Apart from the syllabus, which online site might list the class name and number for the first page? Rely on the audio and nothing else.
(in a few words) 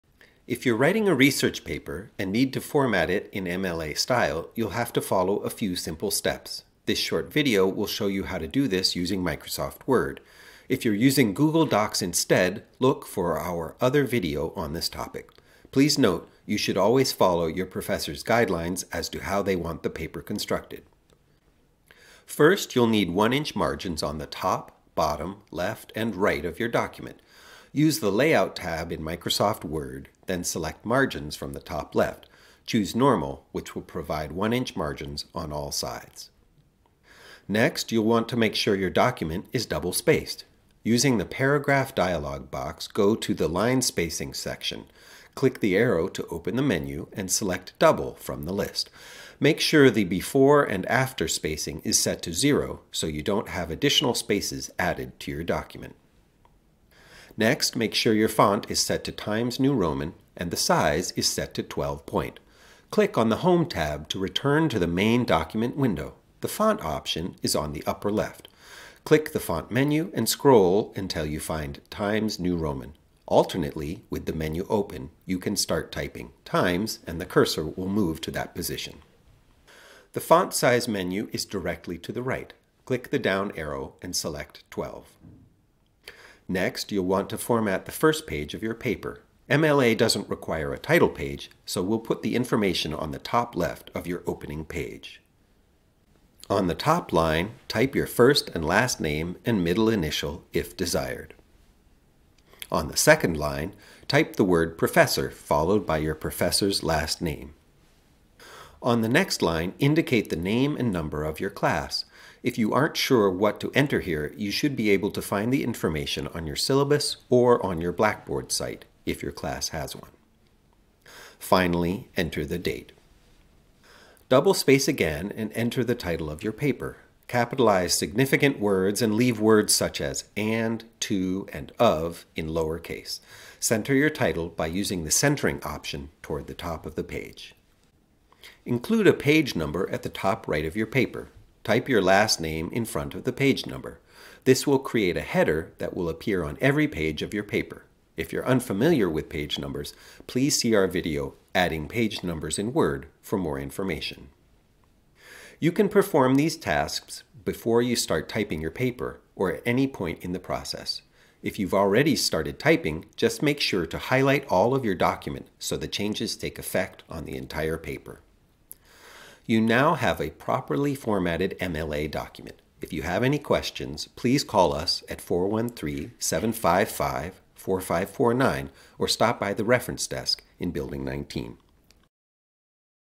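Blackboard.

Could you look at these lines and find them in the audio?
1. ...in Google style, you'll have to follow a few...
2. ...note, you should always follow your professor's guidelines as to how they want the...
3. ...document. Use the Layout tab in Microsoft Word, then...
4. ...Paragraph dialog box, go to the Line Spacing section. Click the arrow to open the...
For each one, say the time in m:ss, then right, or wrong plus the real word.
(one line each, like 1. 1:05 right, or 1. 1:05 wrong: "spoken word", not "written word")
1. 0:03 wrong: "MLA", not "Google"
2. 0:15 right
3. 0:26 right
4. 0:41 right.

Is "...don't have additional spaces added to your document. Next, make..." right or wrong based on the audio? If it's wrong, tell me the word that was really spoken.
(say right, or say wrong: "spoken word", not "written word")
right.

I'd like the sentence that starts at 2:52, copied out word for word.
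If you have any questions, please call us at 413 755 4549 or stop by the reference desk in Building 19.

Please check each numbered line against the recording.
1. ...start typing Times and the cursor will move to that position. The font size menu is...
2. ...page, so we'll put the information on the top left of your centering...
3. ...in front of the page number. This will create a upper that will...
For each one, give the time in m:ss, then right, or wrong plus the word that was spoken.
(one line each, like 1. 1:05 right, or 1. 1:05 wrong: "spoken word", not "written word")
1. 1:15 right
2. 1:31 wrong: "opening", not "centering"
3. 2:22 wrong: "header", not "upper".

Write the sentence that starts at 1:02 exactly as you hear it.
Click on the Home tab to return to the main document window.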